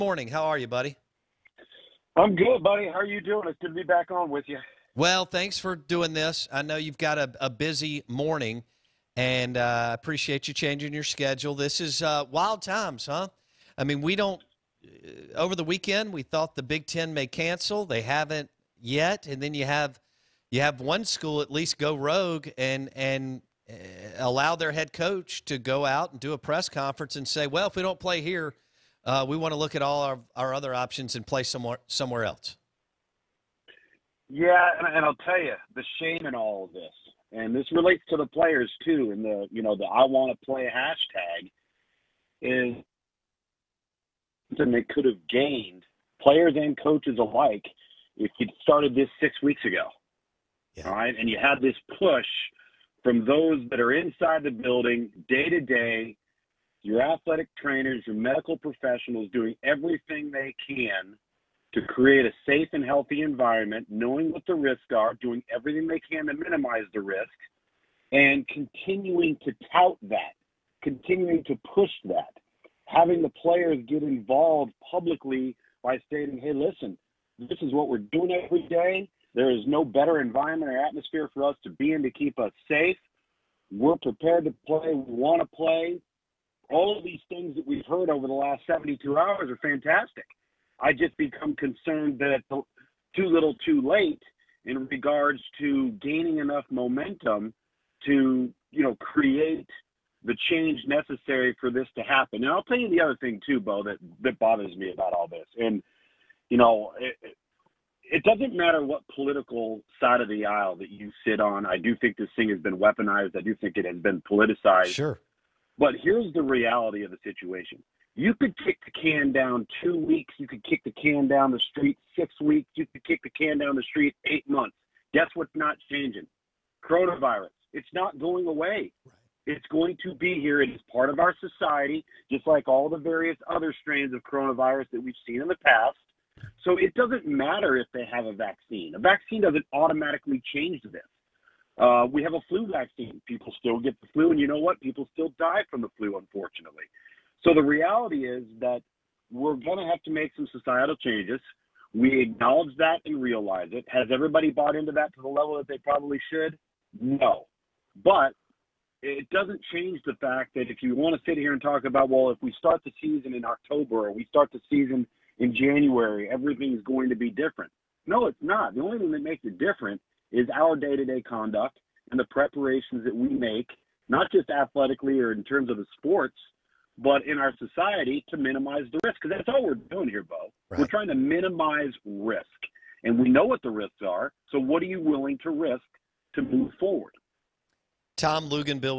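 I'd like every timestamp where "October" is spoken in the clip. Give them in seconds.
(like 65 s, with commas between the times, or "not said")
163 s.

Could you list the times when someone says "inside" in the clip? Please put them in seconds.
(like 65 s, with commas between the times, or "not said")
53 s.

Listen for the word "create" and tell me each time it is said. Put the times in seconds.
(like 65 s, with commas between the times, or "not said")
61 s, 98 s.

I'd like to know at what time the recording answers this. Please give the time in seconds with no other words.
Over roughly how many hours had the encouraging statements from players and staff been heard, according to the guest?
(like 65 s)
88 s.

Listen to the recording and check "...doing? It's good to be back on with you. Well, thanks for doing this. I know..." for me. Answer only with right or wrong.
right.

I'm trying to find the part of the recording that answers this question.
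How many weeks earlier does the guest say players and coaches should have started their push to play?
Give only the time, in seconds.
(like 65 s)
49 s.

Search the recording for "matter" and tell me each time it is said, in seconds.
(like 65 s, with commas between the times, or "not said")
108 s, 137 s.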